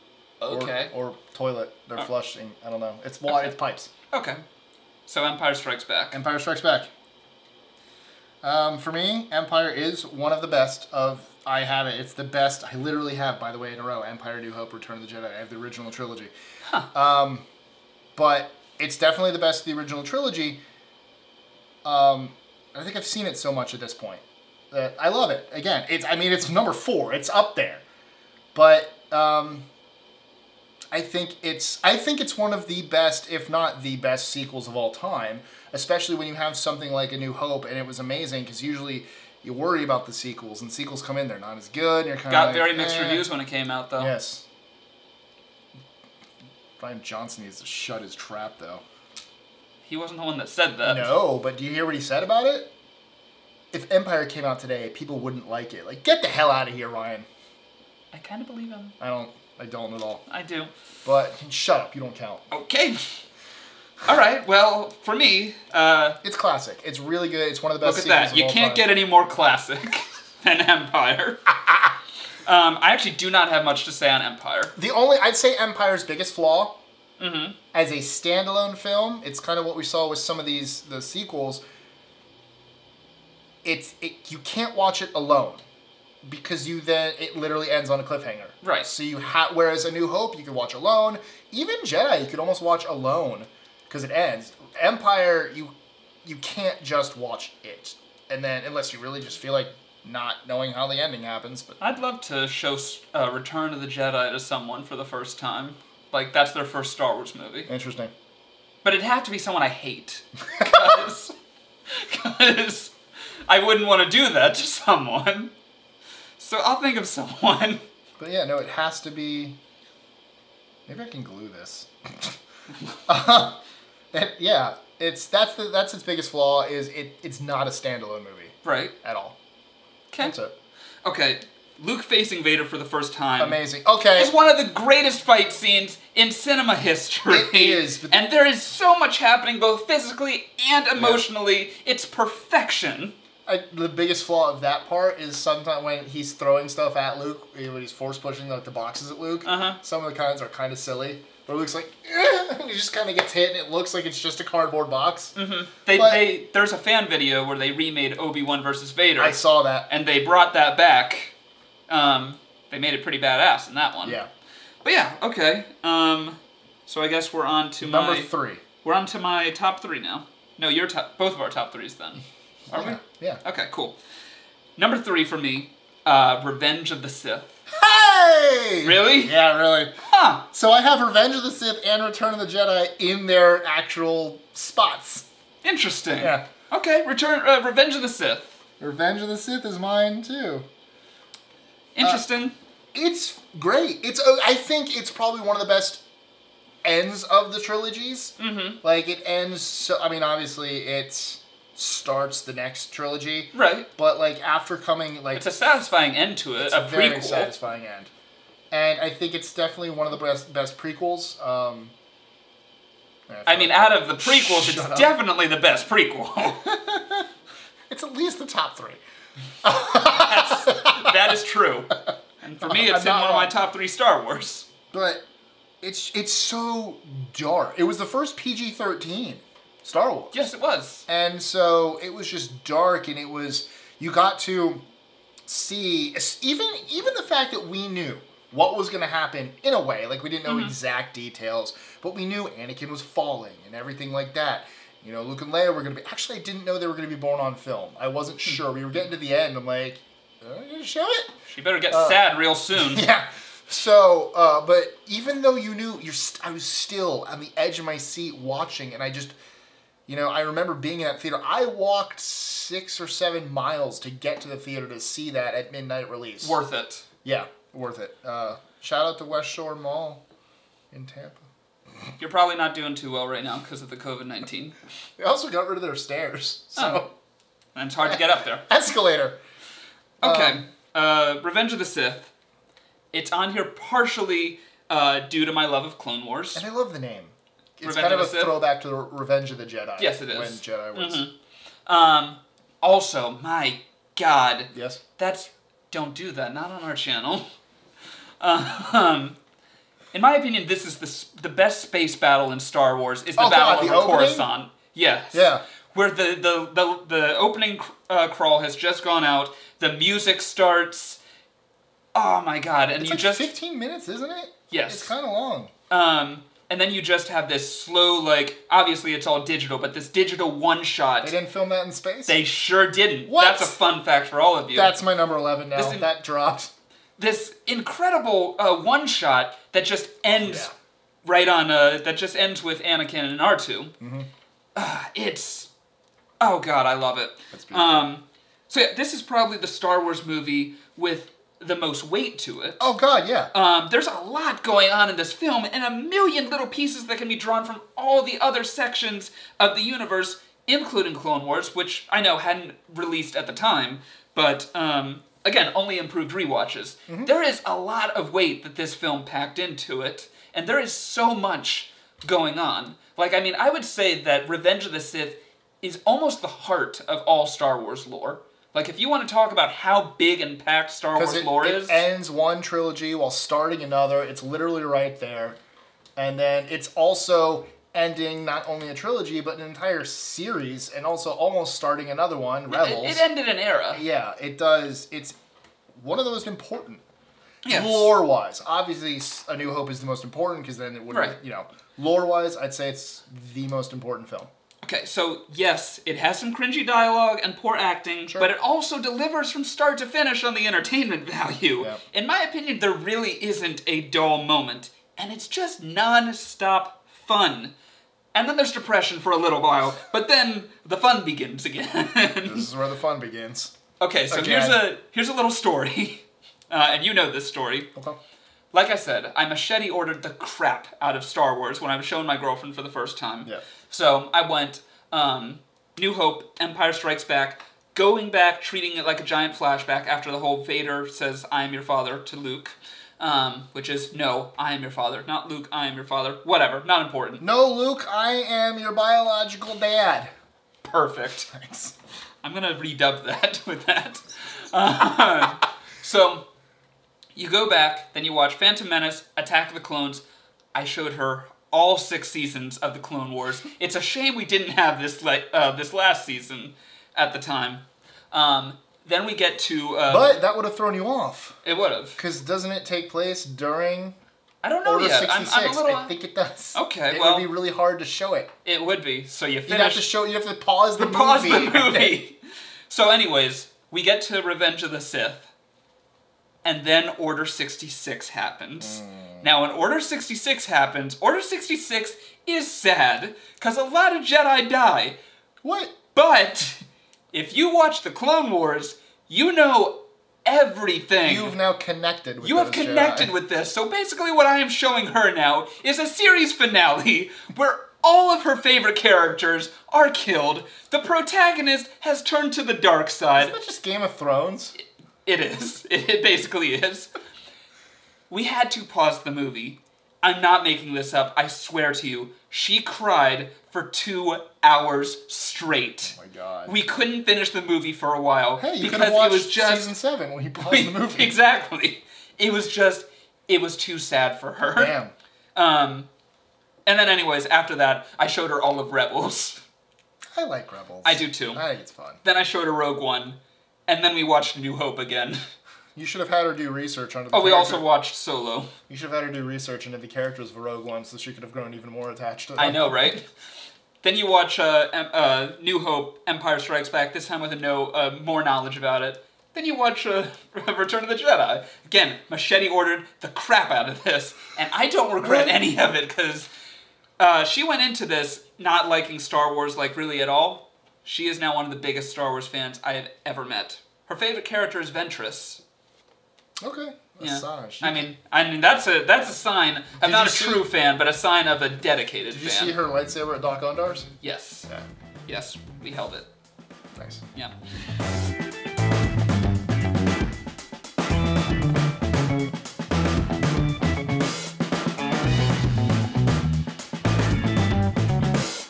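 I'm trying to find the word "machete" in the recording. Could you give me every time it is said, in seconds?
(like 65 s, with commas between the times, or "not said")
419 s, 552 s.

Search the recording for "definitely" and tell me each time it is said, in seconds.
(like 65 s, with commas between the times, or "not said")
18 s, 209 s, 214 s.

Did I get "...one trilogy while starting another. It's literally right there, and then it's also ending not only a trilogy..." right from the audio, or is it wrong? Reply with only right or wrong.
right.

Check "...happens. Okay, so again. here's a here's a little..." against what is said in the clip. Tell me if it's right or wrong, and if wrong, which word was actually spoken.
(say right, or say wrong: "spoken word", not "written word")
wrong: "begins", not "happens".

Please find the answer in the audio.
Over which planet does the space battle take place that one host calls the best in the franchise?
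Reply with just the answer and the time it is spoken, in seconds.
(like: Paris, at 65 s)
Coruscant, at 304 s.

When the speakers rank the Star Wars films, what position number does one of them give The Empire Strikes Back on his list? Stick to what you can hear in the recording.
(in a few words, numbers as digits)
4.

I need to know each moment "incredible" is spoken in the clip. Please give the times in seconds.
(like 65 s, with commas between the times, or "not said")
327 s.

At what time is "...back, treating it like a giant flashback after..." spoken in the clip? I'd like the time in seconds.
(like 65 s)
428 s.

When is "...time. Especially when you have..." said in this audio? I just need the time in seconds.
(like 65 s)
34 s.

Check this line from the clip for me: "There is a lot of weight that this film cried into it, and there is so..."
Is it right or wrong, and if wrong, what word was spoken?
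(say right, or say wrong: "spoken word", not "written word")
wrong: "packed", not "cried".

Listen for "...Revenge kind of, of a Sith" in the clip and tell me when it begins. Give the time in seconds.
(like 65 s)
287 s.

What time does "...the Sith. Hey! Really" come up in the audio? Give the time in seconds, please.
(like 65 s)
177 s.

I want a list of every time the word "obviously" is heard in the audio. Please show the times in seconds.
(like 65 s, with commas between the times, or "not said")
200 s, 318 s, 388 s.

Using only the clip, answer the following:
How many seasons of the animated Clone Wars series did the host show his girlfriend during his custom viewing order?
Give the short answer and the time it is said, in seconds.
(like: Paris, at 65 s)
6, at 451 s.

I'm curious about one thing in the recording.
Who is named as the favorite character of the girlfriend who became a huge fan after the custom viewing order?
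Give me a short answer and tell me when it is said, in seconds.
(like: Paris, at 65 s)
Ventress, at 564 s.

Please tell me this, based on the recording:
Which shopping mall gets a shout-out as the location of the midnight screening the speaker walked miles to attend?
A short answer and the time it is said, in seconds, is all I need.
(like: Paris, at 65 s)
West Shore Mall, at 269 s.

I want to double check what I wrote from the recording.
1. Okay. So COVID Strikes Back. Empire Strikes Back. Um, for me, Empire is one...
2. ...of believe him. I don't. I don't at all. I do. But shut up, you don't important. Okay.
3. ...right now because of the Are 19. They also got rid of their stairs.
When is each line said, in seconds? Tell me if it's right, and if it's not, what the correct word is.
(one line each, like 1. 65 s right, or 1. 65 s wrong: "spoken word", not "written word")
1. 4 s wrong: "Empire", not "COVID"
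2. 58 s wrong: "count", not "important"
3. 273 s wrong: "COVID", not "Are".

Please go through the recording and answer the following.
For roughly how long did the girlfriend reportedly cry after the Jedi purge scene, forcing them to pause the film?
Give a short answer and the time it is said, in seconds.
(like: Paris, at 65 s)
2 hours, at 513 s.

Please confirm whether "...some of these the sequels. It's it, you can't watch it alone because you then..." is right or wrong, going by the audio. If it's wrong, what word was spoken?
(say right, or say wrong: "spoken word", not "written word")
right.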